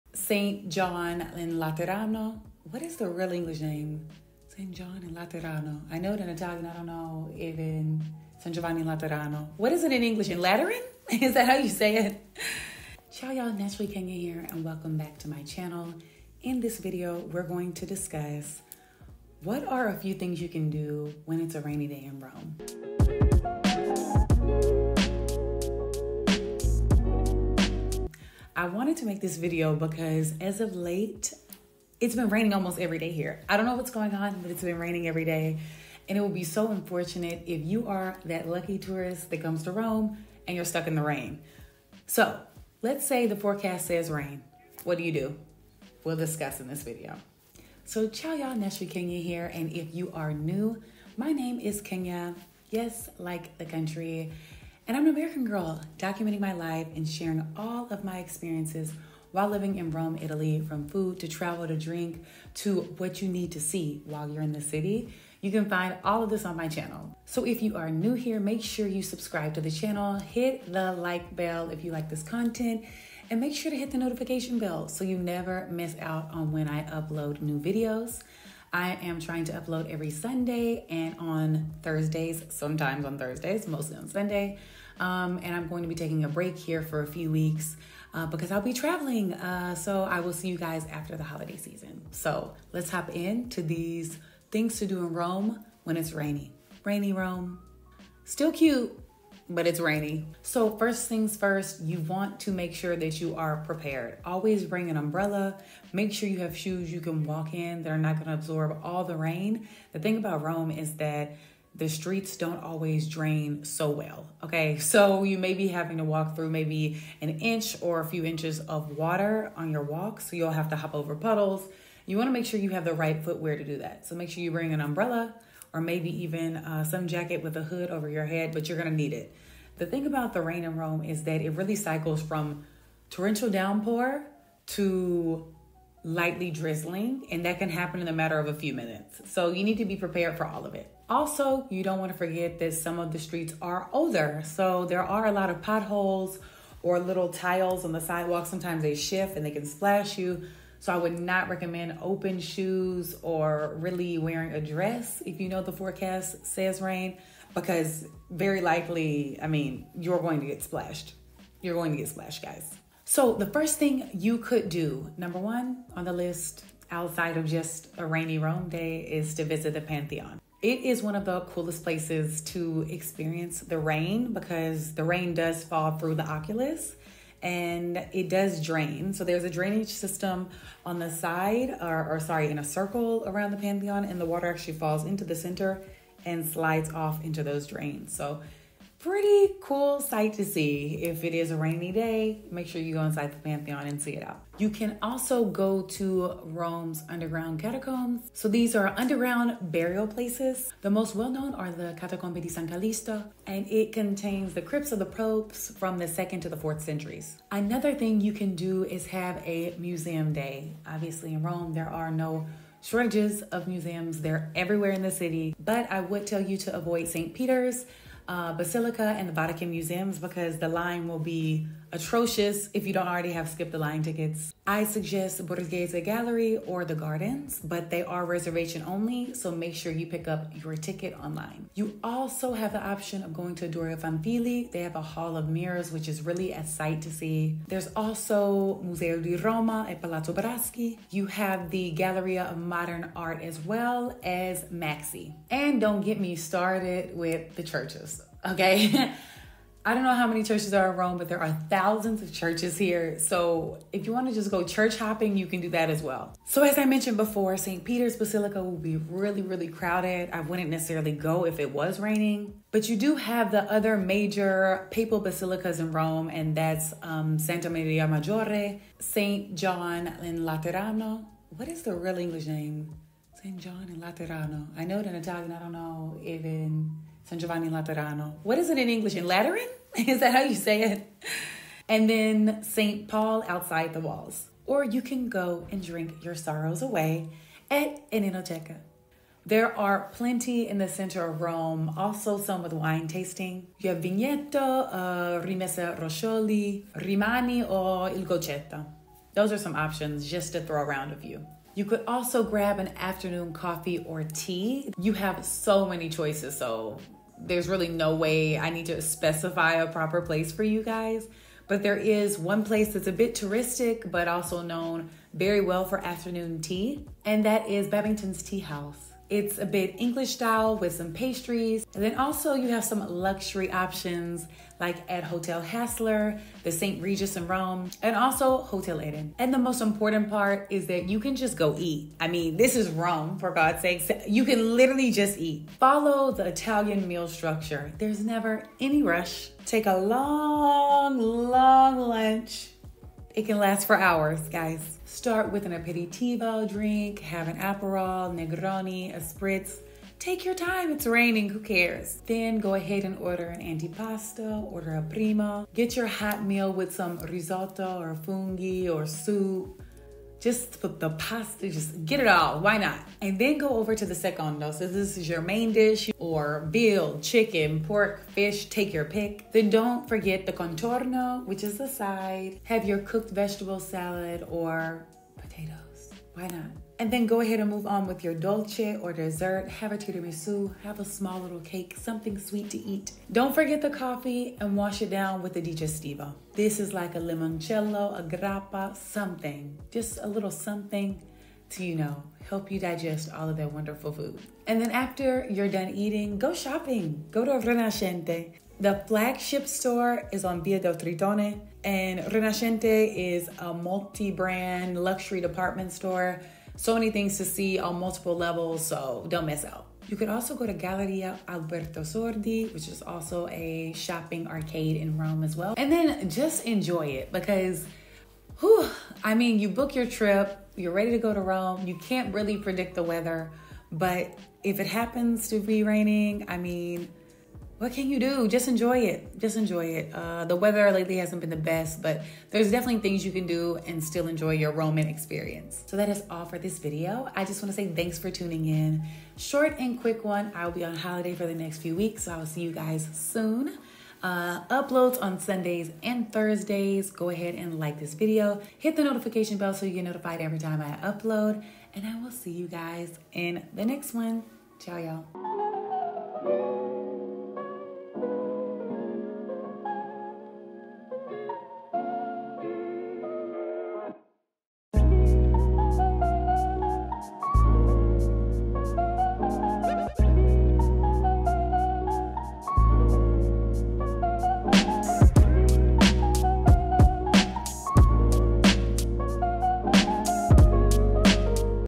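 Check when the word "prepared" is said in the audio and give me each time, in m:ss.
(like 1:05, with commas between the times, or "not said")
1:43, 2:19.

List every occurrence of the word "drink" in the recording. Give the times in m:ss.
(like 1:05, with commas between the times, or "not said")
1:01, 4:45, 5:46.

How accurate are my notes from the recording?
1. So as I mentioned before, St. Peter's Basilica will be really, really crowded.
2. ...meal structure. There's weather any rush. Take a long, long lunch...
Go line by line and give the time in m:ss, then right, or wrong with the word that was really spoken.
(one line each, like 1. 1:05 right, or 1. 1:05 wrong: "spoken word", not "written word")
1. 4:16 right
2. 5:37 wrong: "never", not "weather".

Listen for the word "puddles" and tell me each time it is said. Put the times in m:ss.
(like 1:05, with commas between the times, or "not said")
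2:01.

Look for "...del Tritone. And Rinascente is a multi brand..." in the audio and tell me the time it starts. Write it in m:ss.
6:40.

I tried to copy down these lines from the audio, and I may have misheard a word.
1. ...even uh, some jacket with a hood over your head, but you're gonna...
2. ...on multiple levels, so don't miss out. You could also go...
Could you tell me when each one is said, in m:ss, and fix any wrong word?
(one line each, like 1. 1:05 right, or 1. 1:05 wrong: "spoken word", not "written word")
1. 2:06 right
2. 6:47 right.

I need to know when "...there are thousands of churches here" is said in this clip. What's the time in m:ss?
4:11.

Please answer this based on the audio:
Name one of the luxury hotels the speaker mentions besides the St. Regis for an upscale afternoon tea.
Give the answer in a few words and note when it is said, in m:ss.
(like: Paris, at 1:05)
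Hotel Hassler, at 5:25.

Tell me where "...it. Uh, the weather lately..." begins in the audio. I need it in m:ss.
7:09.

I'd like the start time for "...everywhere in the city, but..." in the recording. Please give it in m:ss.
3:34.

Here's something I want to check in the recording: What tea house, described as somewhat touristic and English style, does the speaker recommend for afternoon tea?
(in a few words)
Babington's Tea House.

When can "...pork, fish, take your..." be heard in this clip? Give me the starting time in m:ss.
6:07.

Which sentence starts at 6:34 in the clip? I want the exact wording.
And then after you're done eating, go shopping.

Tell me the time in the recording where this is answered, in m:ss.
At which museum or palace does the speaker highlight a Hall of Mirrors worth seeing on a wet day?
3:53.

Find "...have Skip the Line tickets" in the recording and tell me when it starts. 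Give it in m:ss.
3:43.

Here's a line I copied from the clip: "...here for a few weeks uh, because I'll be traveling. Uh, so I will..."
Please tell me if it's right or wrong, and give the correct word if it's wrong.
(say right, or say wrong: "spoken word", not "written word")
right.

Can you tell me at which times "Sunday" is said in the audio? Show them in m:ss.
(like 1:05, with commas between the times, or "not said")
1:20, 1:24, 7:25.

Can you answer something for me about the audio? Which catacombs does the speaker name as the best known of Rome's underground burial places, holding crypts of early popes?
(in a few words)
Catacombe di San Callisto.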